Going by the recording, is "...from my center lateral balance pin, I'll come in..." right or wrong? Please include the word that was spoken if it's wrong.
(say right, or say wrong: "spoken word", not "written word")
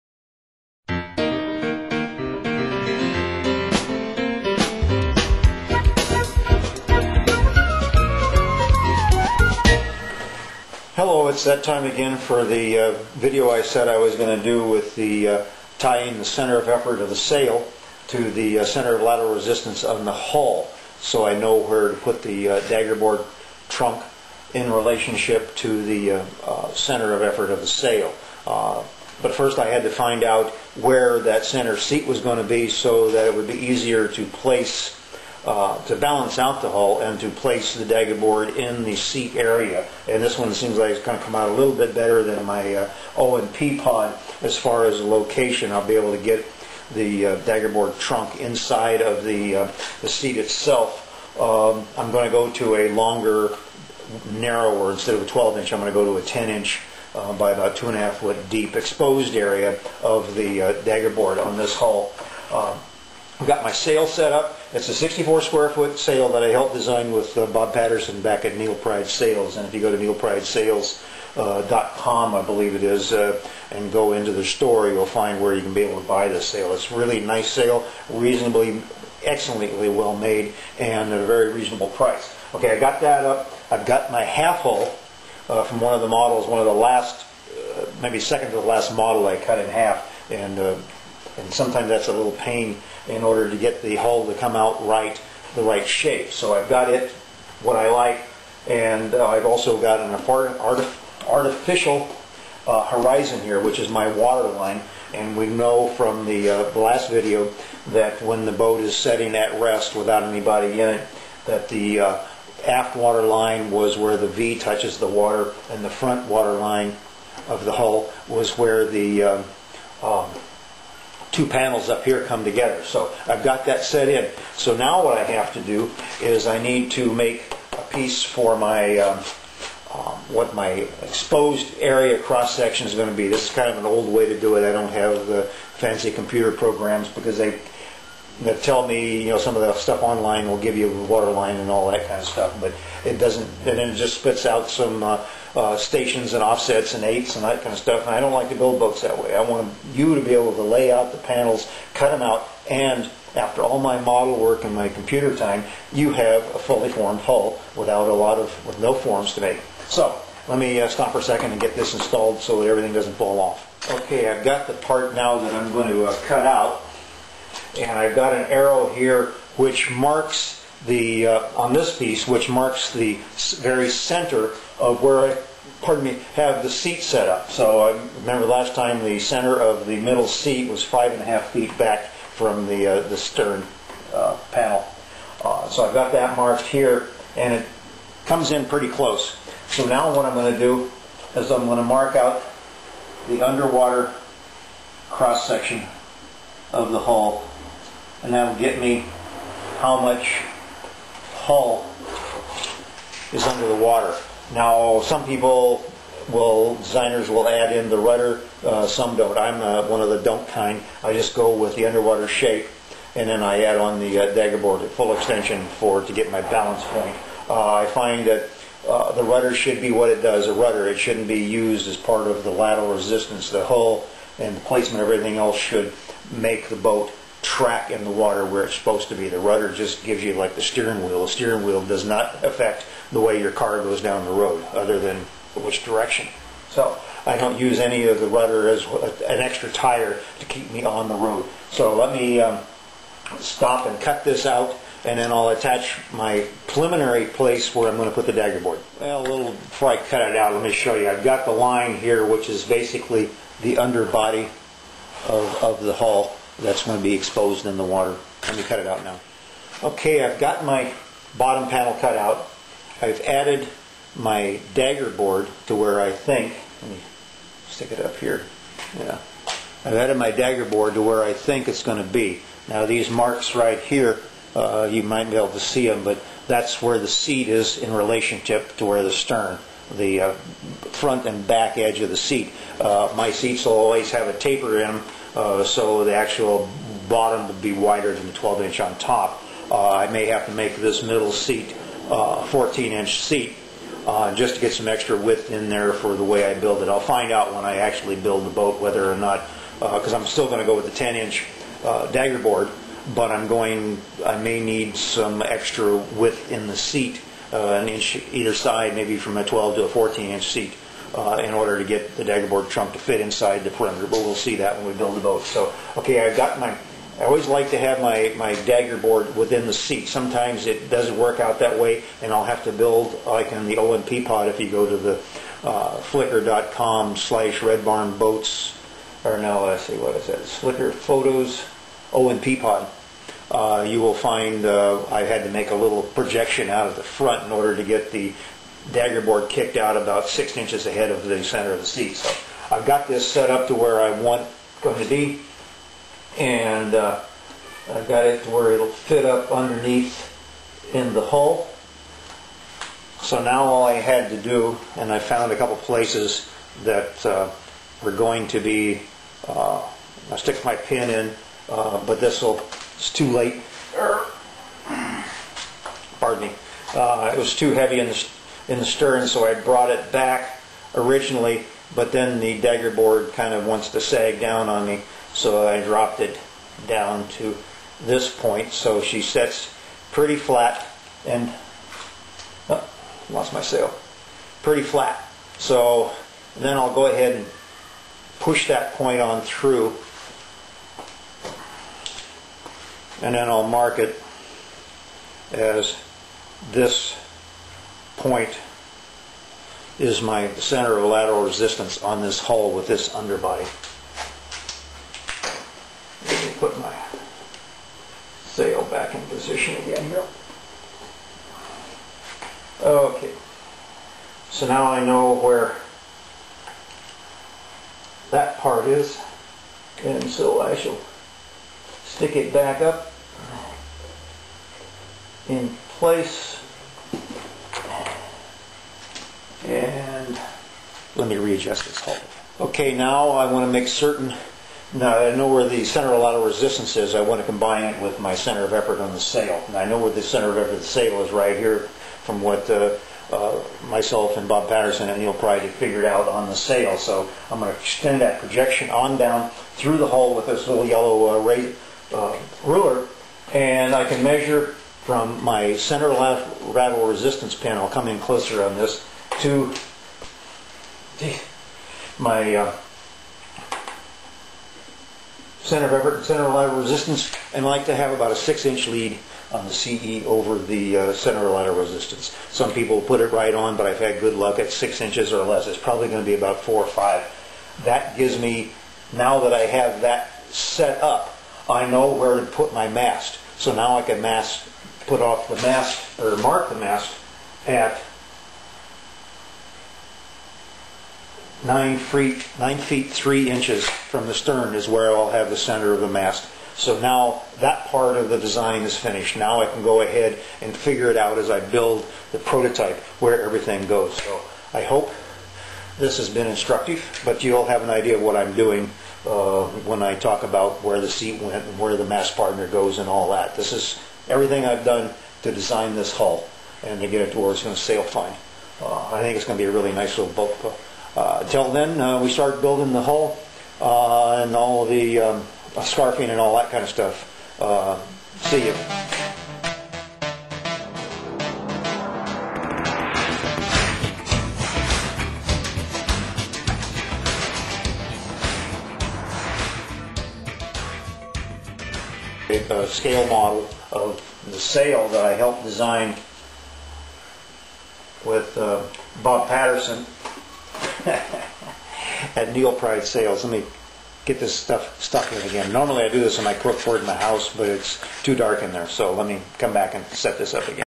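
wrong: "resistance", not "balance".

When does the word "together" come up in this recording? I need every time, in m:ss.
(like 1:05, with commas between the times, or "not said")
2:02.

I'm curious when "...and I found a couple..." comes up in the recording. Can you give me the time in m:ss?
5:54.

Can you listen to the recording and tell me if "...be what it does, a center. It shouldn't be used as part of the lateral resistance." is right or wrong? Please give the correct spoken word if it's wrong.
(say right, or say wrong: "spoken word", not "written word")
wrong: "rudder", not "center".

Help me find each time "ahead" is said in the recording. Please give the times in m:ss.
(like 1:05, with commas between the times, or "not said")
5:40, 6:27, 8:20.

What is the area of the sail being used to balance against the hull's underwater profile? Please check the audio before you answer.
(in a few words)
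64 square feet.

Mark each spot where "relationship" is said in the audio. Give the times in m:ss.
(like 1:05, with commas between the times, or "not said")
0:24, 4:37.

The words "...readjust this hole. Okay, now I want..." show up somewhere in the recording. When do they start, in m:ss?
7:11.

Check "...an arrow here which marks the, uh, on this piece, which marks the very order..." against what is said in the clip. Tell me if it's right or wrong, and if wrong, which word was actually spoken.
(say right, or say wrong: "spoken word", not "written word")
wrong: "center", not "order".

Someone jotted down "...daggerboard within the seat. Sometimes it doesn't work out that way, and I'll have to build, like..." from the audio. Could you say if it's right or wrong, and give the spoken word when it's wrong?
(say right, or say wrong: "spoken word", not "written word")
right.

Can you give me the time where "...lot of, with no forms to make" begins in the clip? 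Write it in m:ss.
2:38.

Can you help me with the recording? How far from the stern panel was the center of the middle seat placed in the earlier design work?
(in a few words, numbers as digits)
5.5 feet.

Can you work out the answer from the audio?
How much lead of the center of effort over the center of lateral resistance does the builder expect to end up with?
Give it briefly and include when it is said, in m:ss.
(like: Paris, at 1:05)
About 4 or 5 inches, at 7:56.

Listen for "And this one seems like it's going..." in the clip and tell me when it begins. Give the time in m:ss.
0:40.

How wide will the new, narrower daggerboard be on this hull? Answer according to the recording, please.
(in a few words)
10 inches.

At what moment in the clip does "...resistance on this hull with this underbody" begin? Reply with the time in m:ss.
6:41.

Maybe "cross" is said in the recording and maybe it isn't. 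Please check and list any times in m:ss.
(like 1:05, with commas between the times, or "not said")
2:12, 3:15.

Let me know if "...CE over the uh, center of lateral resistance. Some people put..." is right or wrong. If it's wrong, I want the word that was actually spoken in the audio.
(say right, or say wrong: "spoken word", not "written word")
right.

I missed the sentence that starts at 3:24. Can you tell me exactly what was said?
Now, some people will, designers will add in the rudder, uh, some don't.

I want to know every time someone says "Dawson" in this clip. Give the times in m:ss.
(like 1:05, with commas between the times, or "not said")
not said.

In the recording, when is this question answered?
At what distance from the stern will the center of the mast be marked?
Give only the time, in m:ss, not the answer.
8:12.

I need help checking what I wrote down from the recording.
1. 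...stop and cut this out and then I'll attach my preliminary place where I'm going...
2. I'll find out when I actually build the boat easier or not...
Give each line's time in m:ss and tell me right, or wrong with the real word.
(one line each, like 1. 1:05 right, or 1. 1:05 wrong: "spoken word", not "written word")
1. 4:03 right
2. 4:56 wrong: "whether", not "easier".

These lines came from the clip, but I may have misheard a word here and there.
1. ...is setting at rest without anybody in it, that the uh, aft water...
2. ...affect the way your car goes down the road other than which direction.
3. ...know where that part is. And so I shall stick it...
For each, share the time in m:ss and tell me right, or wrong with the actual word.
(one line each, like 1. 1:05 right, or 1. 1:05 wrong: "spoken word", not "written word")
1. 1:48 right
2. 3:52 right
3. 6:55 right.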